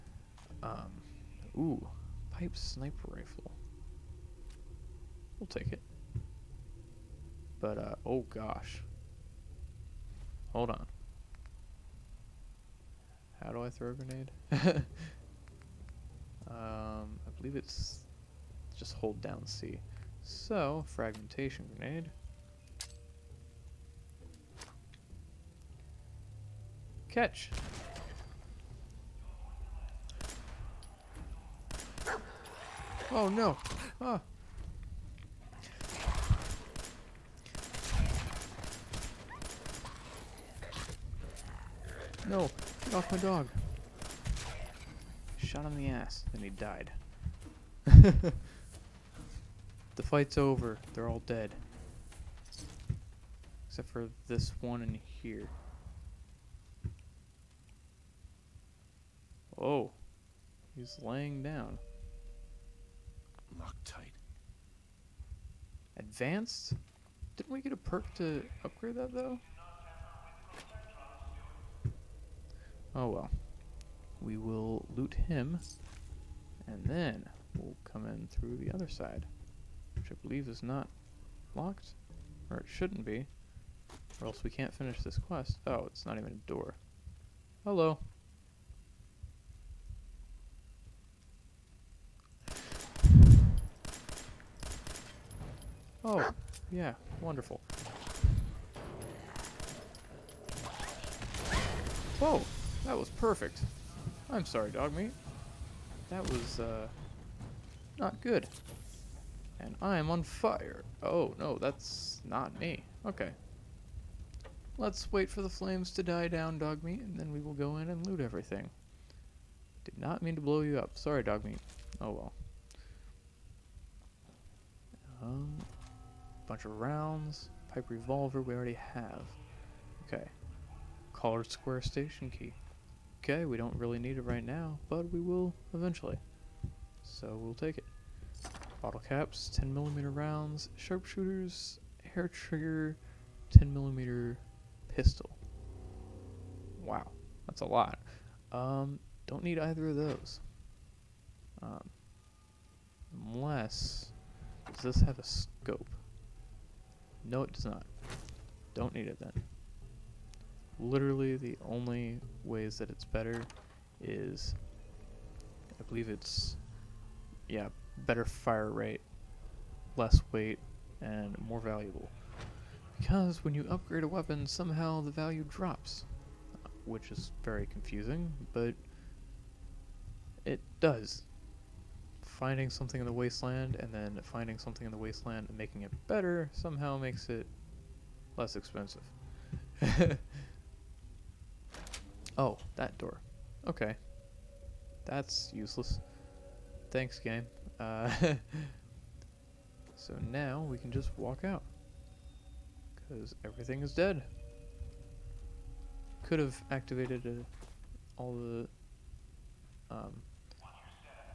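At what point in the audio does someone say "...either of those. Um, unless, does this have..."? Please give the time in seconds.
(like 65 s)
149 s.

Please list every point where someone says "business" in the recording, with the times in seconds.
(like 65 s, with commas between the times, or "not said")
not said.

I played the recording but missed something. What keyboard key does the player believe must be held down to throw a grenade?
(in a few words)
C.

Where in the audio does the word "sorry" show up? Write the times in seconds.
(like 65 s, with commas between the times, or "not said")
104 s, 120 s.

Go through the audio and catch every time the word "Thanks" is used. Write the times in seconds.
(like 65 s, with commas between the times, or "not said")
196 s.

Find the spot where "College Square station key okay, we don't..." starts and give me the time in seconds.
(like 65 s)
131 s.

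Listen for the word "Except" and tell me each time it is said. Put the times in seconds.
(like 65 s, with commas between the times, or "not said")
53 s.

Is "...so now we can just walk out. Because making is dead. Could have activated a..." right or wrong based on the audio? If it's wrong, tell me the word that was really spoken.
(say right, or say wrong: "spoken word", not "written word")
wrong: "everything", not "making".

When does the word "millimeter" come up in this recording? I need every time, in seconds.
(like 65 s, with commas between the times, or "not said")
139 s, 143 s.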